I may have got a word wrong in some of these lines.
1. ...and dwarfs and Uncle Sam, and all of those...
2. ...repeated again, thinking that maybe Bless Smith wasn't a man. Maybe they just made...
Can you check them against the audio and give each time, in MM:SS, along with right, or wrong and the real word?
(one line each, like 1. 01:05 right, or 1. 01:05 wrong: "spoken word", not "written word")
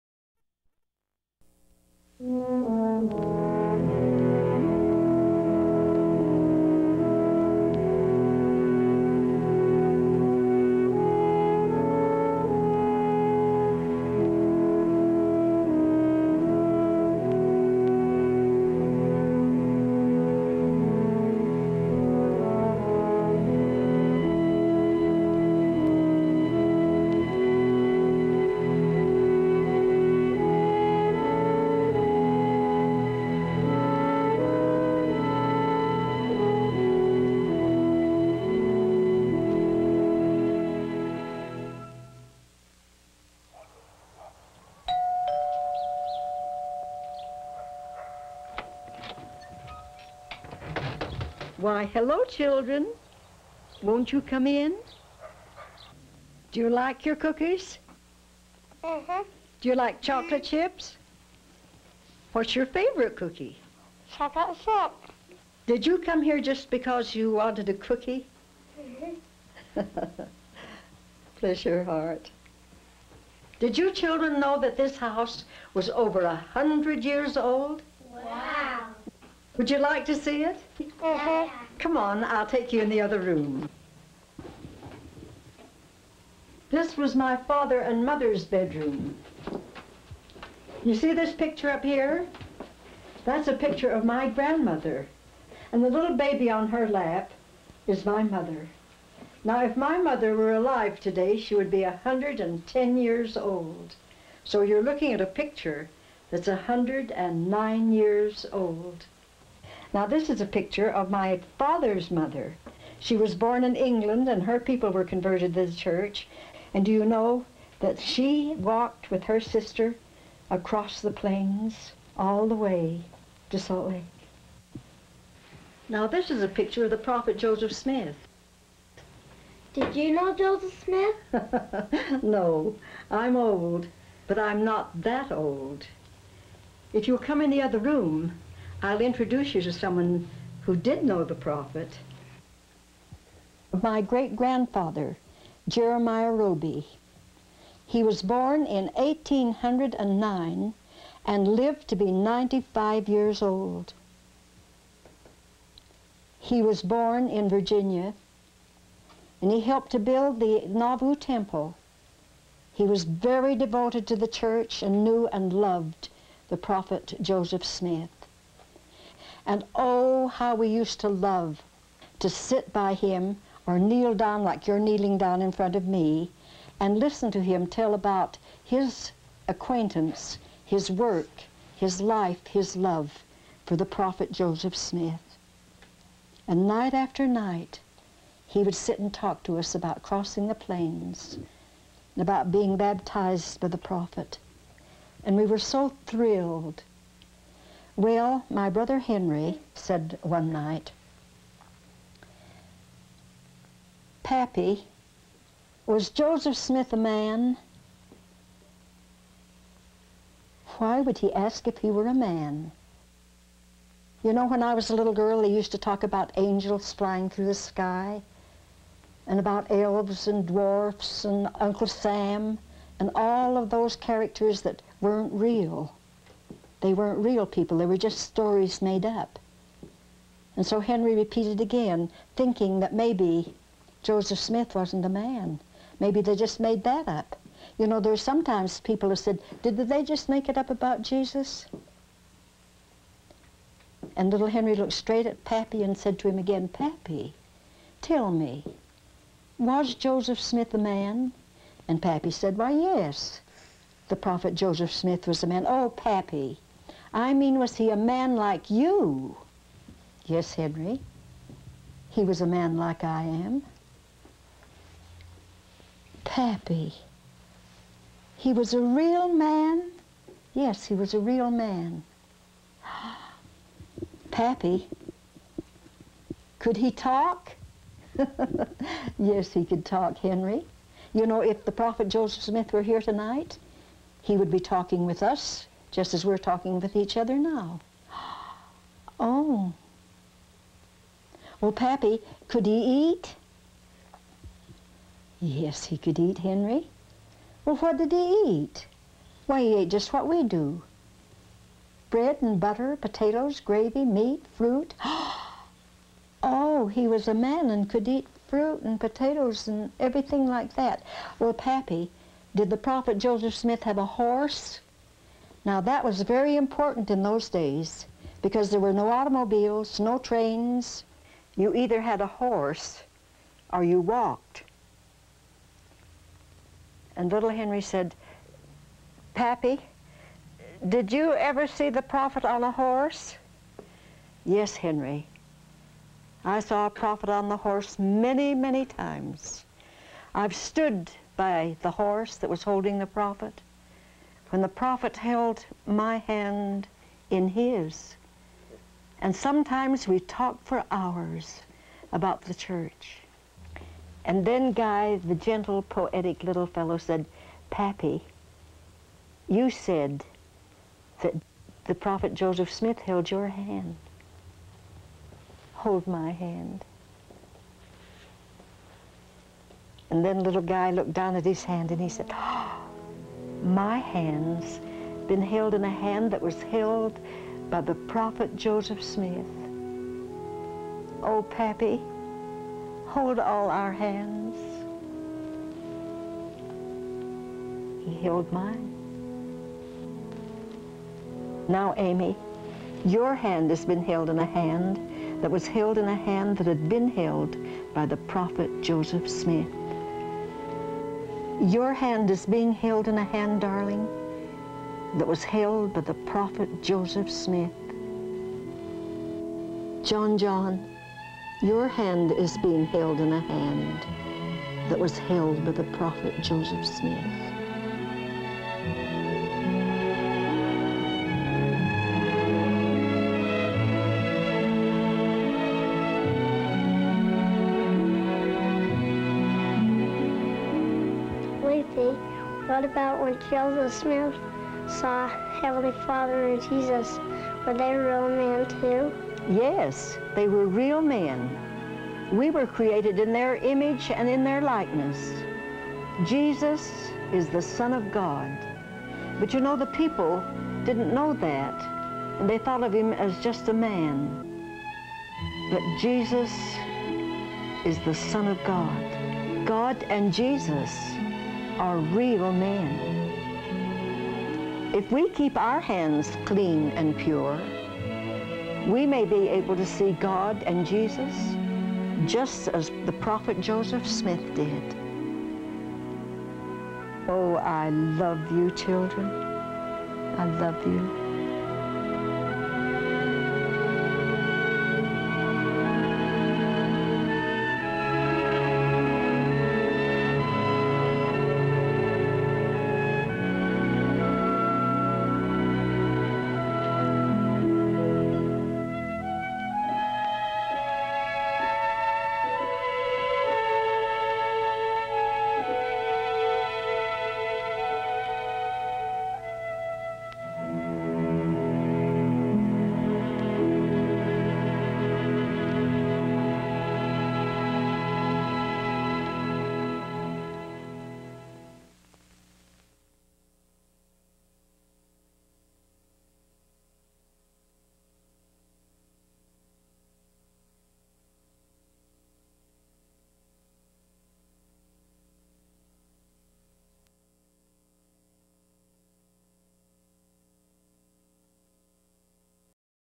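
1. 03:40 right
2. 03:51 wrong: "Joseph", not "Bless".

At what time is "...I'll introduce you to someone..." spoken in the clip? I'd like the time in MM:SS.
02:18.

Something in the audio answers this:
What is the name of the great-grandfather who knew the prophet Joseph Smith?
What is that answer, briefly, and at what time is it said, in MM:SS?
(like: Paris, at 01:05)
Jeremiah Roby, at 02:25.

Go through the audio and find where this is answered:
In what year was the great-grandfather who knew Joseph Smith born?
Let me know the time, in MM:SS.
02:28.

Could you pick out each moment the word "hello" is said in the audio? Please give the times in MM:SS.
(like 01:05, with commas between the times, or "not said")
00:51.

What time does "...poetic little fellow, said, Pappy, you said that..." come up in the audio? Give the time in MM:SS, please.
05:55.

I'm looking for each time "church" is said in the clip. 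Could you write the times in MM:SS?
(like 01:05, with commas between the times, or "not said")
01:55, 02:44, 05:52.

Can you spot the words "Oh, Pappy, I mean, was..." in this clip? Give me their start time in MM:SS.
04:15.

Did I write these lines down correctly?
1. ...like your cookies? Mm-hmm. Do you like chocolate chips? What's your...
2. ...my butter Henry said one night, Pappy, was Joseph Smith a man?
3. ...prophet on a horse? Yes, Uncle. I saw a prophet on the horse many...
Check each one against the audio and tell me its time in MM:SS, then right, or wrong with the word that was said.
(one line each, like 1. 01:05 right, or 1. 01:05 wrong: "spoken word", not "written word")
1. 00:56 right
2. 03:18 wrong: "brother", not "butter"
3. 05:32 wrong: "Henry", not "Uncle".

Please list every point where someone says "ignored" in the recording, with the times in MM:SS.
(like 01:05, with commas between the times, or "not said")
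not said.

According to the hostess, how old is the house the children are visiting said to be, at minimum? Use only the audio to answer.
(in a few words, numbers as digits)
Over 100 years.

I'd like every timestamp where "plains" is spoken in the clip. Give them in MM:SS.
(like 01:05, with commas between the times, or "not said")
02:01, 03:10.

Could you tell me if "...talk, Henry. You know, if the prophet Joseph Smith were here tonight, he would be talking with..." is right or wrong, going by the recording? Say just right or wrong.
right.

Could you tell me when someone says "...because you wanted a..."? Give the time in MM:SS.
01:06.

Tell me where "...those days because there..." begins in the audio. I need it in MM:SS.
05:17.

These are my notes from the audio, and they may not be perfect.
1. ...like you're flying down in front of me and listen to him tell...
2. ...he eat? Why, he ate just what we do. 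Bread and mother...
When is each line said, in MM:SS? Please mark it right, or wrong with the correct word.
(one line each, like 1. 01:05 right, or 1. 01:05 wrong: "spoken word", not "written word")
1. 02:54 wrong: "kneeling", not "flying"
2. 04:58 wrong: "butter", not "mother".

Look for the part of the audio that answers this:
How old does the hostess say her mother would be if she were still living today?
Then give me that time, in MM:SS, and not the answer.
01:41.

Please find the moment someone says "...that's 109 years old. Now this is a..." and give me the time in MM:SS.
01:46.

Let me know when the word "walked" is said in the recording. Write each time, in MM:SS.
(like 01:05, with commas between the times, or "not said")
01:58, 05:24.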